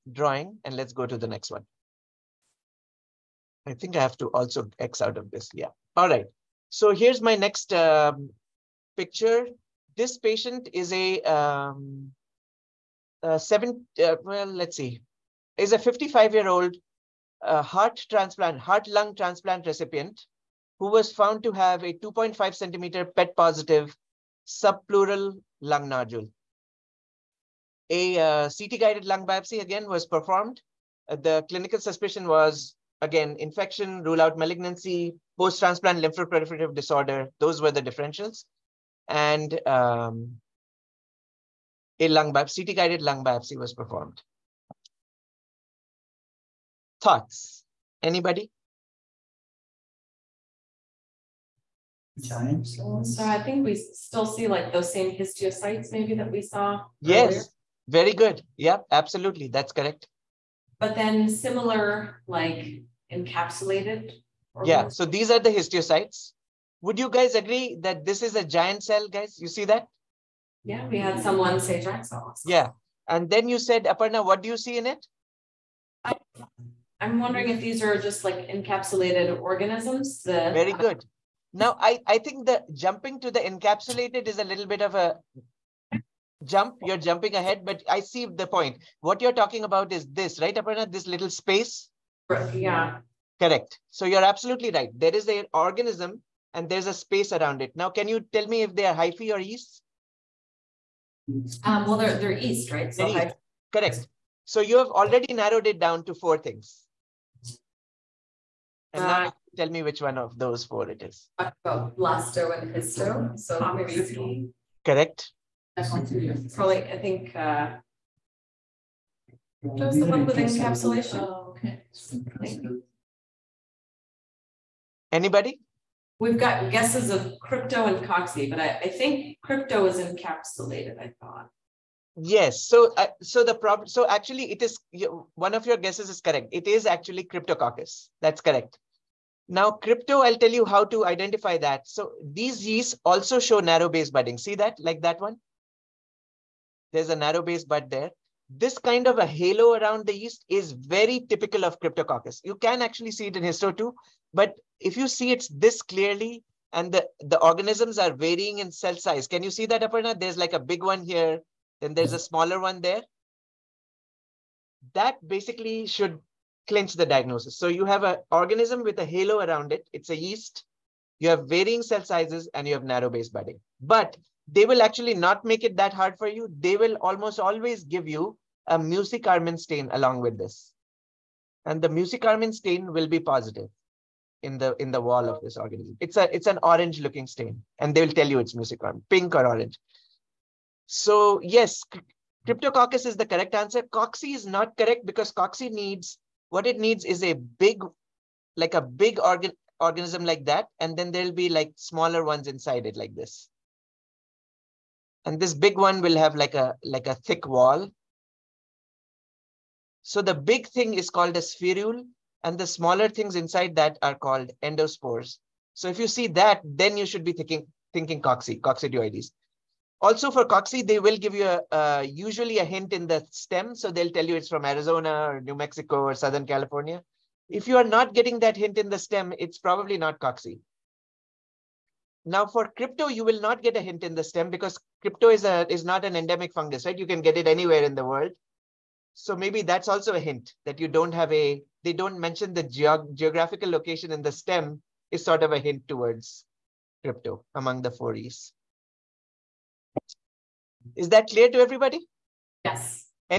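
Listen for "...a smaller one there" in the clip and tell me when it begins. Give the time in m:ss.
2:42.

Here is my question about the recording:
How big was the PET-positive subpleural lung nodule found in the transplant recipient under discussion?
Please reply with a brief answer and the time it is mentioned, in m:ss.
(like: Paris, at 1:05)
2.5 centimeters, at 0:21.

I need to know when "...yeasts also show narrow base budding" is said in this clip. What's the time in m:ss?
2:22.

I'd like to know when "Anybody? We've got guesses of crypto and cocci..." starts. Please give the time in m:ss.
2:05.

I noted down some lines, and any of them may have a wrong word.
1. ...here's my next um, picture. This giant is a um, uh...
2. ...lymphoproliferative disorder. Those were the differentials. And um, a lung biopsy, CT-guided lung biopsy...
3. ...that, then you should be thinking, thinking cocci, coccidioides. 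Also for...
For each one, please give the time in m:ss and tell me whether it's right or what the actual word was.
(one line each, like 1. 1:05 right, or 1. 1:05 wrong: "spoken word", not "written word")
1. 0:06 wrong: "patient", not "giant"
2. 0:36 right
3. 3:36 right.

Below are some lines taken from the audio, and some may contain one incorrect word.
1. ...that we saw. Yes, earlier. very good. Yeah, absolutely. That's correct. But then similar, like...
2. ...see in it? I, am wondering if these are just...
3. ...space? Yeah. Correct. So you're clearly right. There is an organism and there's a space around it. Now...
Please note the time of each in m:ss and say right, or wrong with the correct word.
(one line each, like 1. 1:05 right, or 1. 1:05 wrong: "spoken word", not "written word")
1. 0:56 right
2. 1:14 right
3. 1:31 wrong: "absolutely", not "clearly".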